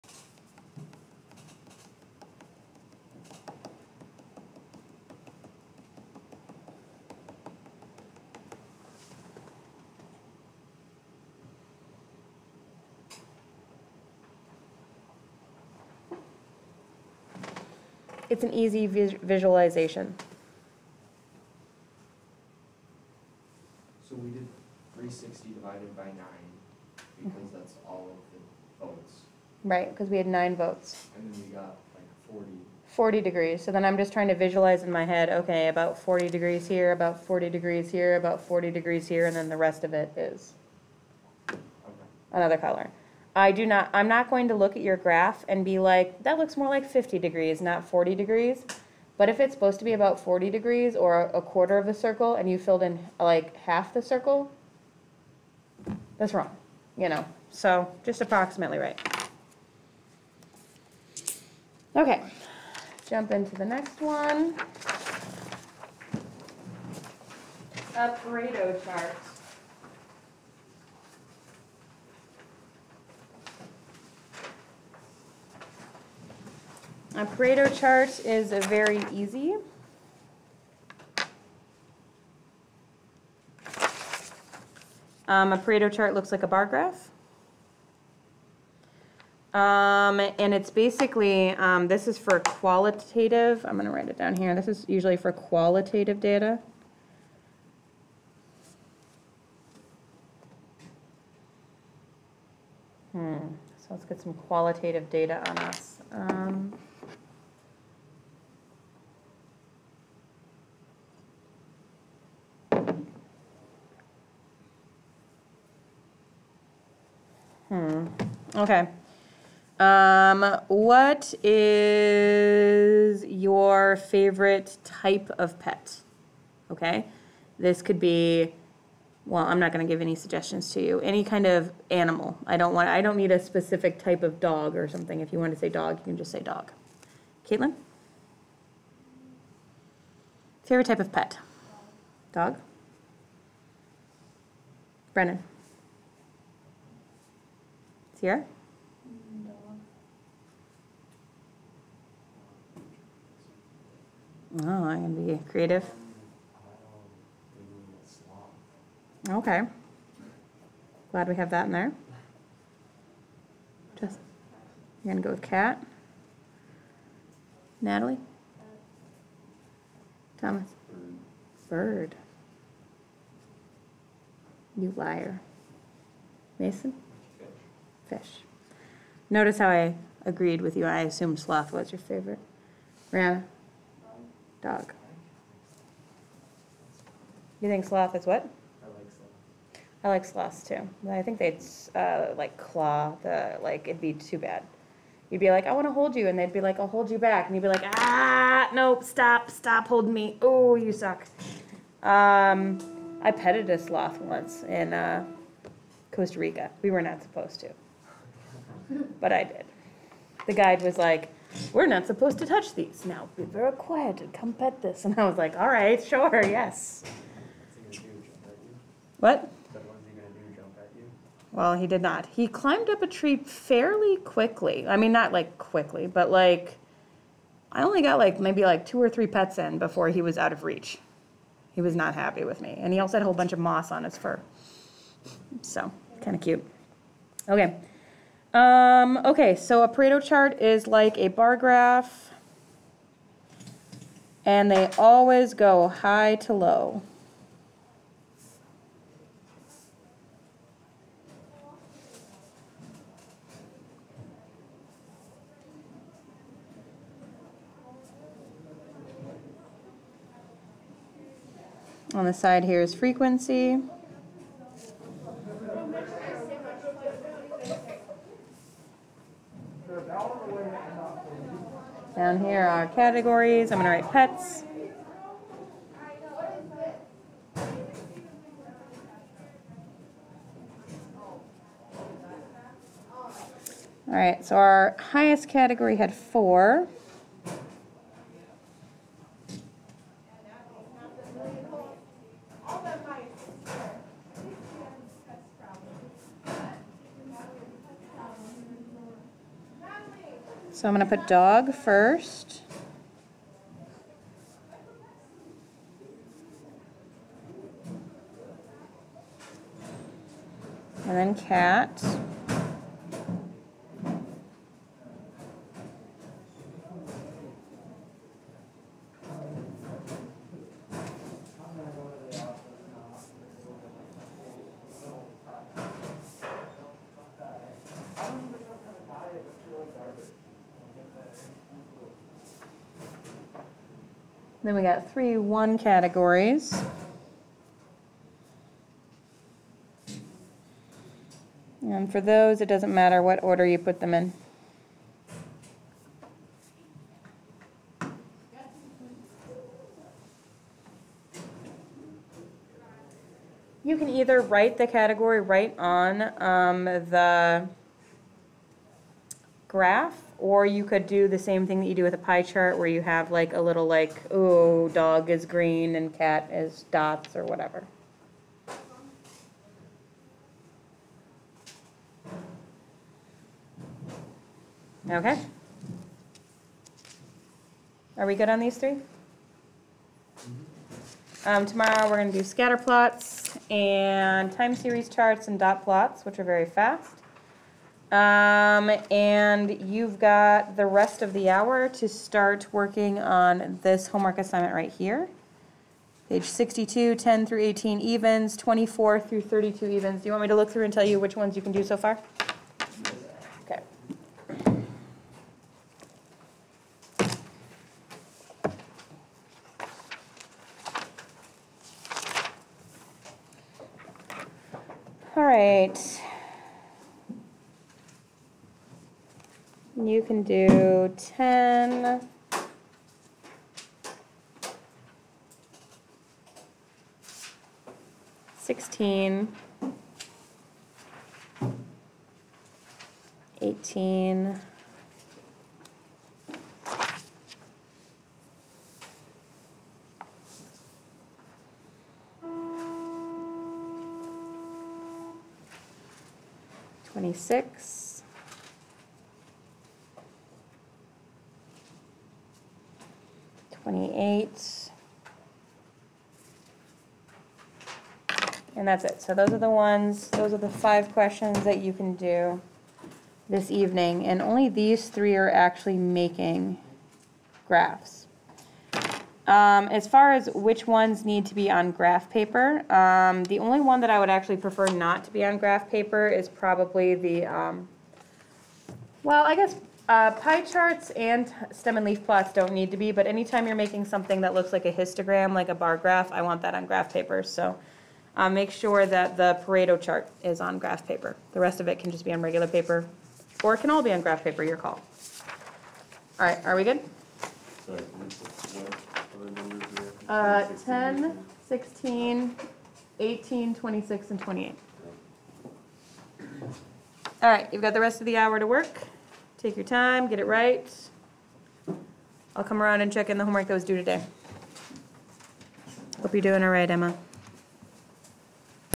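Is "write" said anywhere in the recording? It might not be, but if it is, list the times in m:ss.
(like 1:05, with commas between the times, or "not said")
1:33, 4:34, 5:54.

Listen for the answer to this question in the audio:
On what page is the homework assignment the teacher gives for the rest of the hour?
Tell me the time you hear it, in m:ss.
6:36.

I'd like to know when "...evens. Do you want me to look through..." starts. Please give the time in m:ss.
6:39.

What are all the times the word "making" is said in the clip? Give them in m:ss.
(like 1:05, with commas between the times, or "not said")
7:45, 8:03.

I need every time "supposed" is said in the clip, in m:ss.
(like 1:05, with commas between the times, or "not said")
0:49, 3:27, 3:32.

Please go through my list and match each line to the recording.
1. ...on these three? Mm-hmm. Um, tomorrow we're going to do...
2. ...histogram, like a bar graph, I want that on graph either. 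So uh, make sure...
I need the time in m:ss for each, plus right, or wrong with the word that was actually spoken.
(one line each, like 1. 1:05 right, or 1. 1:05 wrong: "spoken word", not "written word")
1. 6:18 right
2. 8:04 wrong: "paper", not "either".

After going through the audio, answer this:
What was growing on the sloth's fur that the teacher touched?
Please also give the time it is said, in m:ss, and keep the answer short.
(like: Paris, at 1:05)
Moss, at 3:53.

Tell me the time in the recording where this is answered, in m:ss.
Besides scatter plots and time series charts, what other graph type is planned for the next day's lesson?
6:25.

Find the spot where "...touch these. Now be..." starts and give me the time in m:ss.
3:32.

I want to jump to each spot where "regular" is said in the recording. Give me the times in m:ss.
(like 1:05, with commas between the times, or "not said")
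8:12.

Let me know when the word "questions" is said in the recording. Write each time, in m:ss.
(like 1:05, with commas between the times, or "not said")
7:41.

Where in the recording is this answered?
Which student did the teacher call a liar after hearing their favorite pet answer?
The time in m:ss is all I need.
2:50.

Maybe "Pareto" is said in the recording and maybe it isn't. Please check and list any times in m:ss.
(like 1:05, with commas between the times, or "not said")
1:08, 1:17, 1:25, 3:59, 8:09.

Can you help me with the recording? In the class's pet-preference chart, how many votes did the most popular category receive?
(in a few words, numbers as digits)
4.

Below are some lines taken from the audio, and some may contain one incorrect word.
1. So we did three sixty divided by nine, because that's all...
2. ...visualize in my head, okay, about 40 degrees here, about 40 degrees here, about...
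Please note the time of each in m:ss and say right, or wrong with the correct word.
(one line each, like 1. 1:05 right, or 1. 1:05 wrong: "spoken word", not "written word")
1. 0:24 right
2. 0:34 right.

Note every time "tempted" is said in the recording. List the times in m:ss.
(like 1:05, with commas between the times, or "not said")
not said.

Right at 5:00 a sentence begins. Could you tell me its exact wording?
So I'm going to put dog first.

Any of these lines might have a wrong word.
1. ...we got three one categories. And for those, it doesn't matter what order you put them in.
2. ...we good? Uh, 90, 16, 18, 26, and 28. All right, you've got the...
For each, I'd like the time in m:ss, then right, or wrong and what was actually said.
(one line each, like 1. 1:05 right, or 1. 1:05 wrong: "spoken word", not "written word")
1. 5:34 right
2. 8:16 wrong: "10", not "90".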